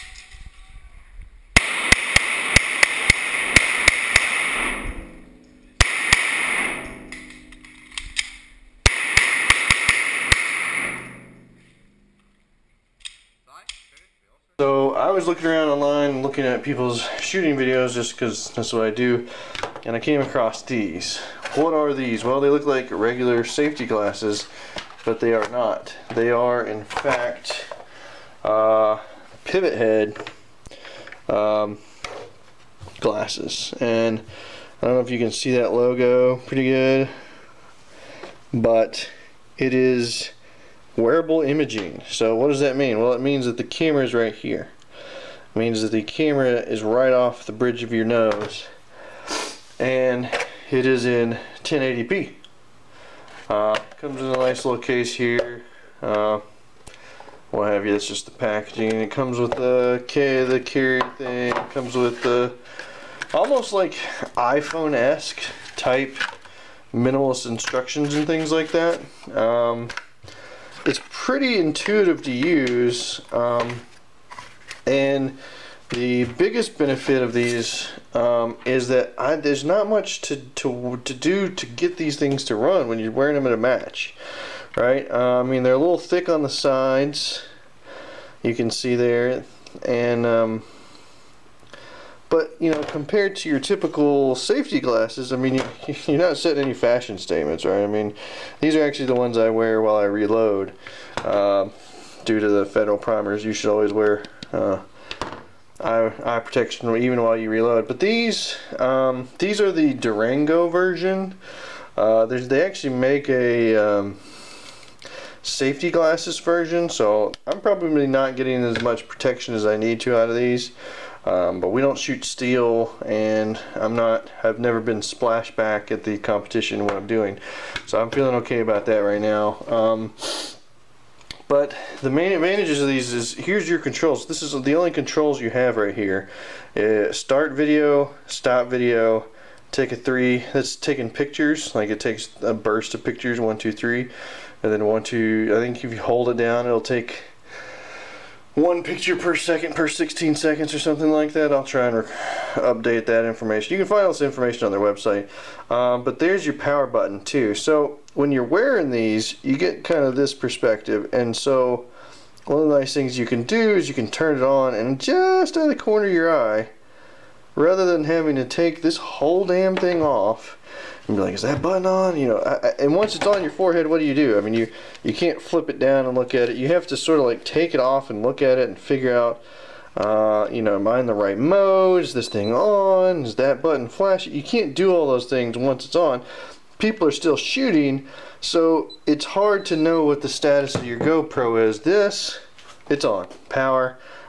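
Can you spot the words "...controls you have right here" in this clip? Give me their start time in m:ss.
2:14.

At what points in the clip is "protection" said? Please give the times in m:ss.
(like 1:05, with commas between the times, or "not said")
1:46, 1:59.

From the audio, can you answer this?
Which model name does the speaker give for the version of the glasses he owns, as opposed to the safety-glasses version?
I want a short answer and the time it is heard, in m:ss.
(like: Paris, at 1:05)
Durango, at 1:49.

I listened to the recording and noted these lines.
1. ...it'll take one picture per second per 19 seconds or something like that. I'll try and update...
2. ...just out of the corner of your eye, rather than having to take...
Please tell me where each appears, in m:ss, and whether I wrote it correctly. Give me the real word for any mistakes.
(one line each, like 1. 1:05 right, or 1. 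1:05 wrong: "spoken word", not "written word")
1. 2:26 wrong: "16", not "19"
2. 2:45 right.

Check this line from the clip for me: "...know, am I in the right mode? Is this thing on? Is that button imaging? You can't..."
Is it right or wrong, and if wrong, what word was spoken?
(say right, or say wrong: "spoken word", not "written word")
wrong: "flashing", not "imaging".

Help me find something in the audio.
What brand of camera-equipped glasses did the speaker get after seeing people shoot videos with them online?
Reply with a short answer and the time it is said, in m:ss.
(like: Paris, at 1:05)
Pivothead, at 0:29.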